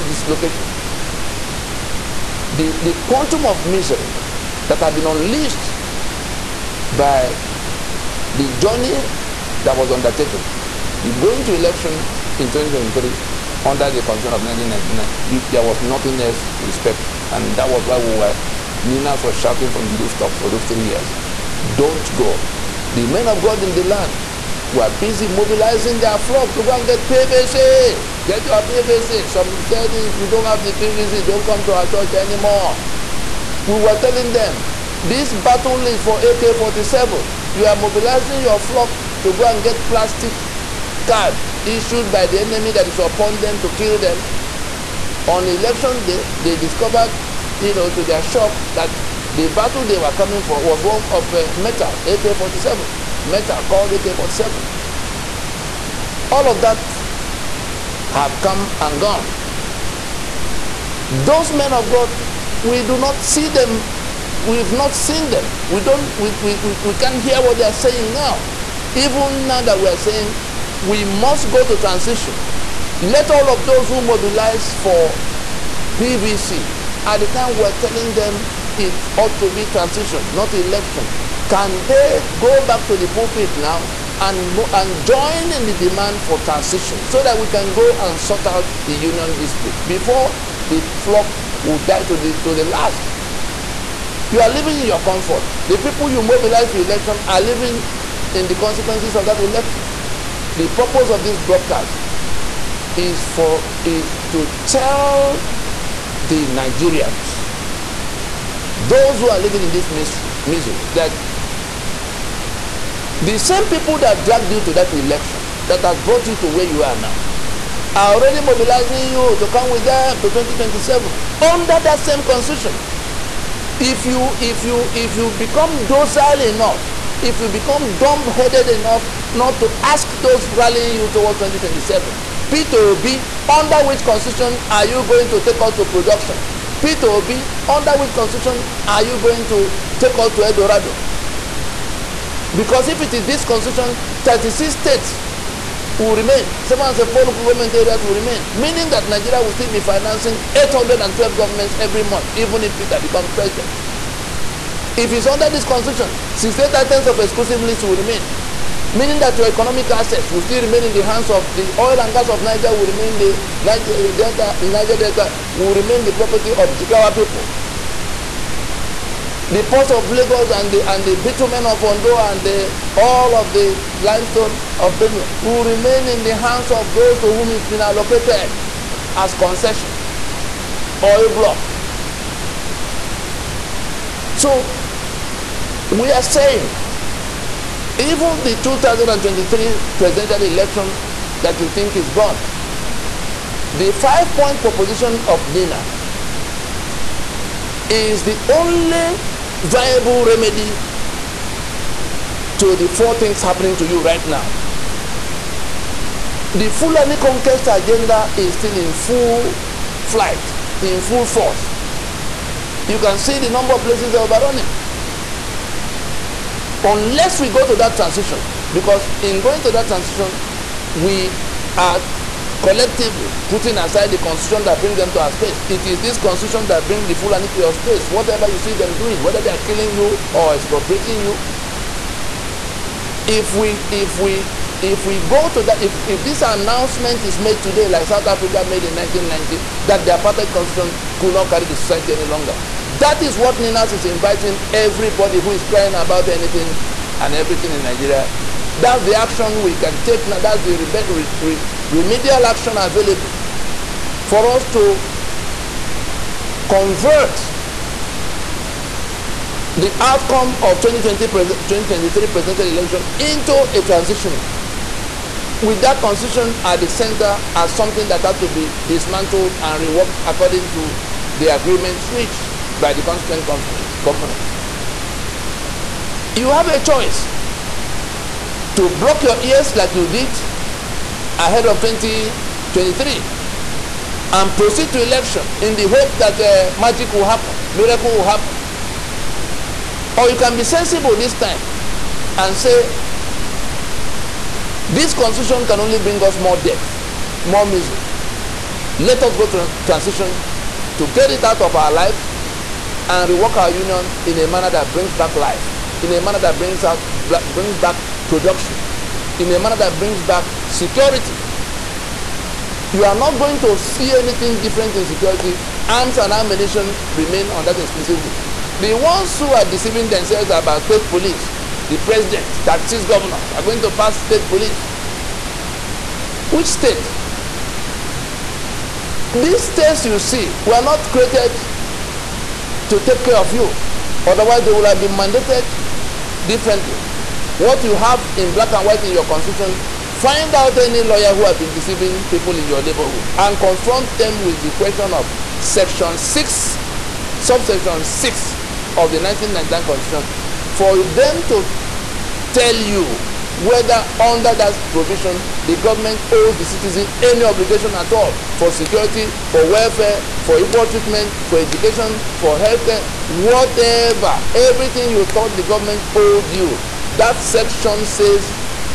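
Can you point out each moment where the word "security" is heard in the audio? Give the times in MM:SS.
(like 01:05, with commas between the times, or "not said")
05:10, 05:15, 05:58.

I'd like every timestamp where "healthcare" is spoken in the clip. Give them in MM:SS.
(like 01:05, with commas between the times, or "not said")
06:02.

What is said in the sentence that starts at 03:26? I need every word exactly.
The Fulani conquest agenda is still in full flight, in full force.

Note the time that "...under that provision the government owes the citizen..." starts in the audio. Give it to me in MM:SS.
05:54.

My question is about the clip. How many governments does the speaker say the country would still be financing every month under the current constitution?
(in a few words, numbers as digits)
812.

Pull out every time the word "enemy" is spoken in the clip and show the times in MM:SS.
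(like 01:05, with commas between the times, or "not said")
00:42.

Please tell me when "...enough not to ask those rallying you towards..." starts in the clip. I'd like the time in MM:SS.
02:08.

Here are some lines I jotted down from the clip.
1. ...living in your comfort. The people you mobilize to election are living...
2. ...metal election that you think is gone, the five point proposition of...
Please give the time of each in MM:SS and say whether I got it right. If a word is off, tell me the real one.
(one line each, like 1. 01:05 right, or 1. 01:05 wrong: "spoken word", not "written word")
1. 01:34 right
2. 03:09 wrong: "presidential", not "metal".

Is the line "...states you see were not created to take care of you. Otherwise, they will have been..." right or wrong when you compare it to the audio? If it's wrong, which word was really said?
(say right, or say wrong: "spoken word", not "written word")
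right.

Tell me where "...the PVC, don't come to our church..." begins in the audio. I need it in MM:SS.
00:30.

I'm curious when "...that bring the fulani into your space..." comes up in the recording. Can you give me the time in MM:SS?
03:46.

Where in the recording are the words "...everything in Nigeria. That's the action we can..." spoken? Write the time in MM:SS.
04:07.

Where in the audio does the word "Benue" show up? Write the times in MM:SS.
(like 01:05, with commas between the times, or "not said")
02:54.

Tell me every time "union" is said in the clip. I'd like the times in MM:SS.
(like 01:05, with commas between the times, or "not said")
01:28, 05:03.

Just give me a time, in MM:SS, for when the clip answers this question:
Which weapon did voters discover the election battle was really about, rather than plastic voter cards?
00:53.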